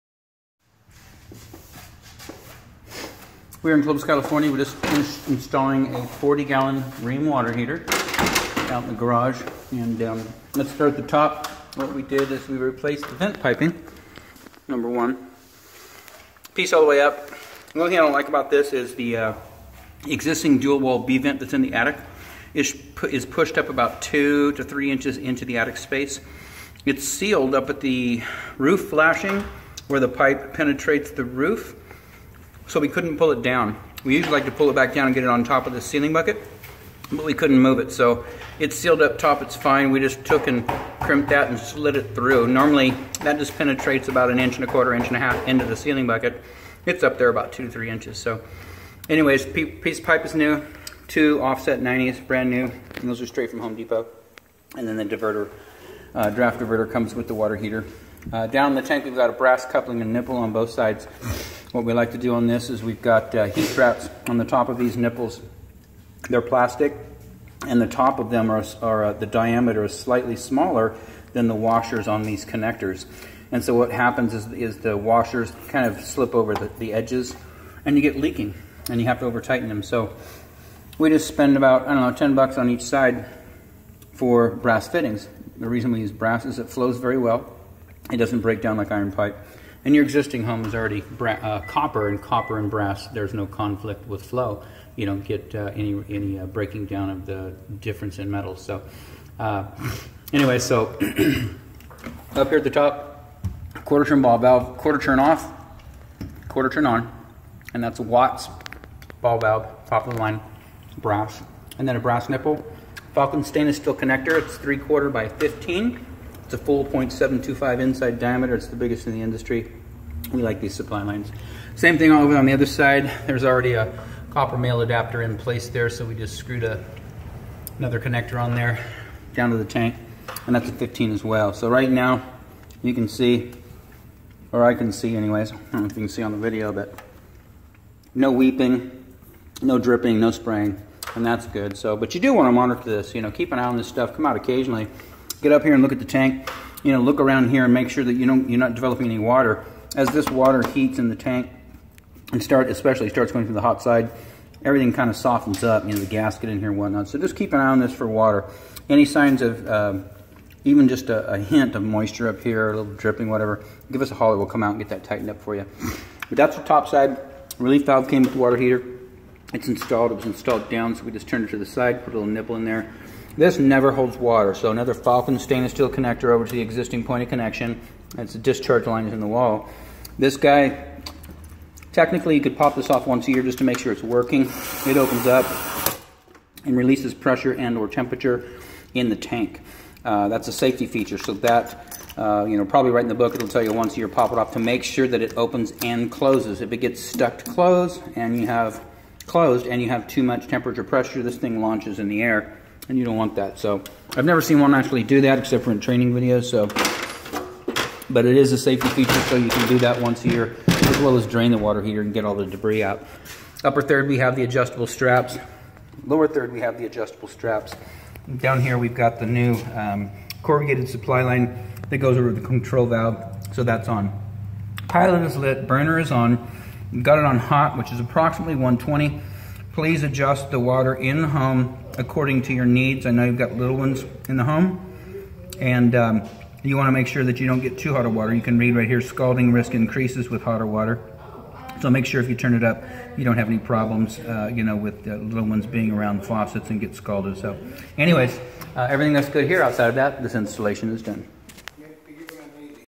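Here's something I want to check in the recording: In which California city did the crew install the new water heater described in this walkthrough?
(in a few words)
Clovis.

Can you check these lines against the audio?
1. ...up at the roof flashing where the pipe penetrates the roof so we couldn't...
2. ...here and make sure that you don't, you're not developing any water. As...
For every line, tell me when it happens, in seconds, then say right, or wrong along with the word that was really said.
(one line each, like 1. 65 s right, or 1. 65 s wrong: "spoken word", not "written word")
1. 27 s right
2. 147 s right.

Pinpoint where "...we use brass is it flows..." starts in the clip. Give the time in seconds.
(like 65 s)
85 s.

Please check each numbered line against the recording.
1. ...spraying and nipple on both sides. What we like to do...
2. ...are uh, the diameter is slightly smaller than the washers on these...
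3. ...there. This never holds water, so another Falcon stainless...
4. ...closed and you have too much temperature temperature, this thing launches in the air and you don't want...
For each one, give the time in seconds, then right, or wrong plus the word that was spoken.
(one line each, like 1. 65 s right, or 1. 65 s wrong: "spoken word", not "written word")
1. 59 s wrong: "coupling", not "spraying"
2. 68 s right
3. 172 s right
4. 199 s wrong: "pressure", not "temperature".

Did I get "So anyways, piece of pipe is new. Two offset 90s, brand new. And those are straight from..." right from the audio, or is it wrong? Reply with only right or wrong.
right.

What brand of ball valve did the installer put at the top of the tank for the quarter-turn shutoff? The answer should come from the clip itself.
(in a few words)
Watts.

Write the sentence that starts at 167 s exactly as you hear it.
Relief valve came with the water heater.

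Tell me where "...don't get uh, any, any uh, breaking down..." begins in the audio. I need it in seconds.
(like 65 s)
95 s.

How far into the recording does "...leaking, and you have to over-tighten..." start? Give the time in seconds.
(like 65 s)
78 s.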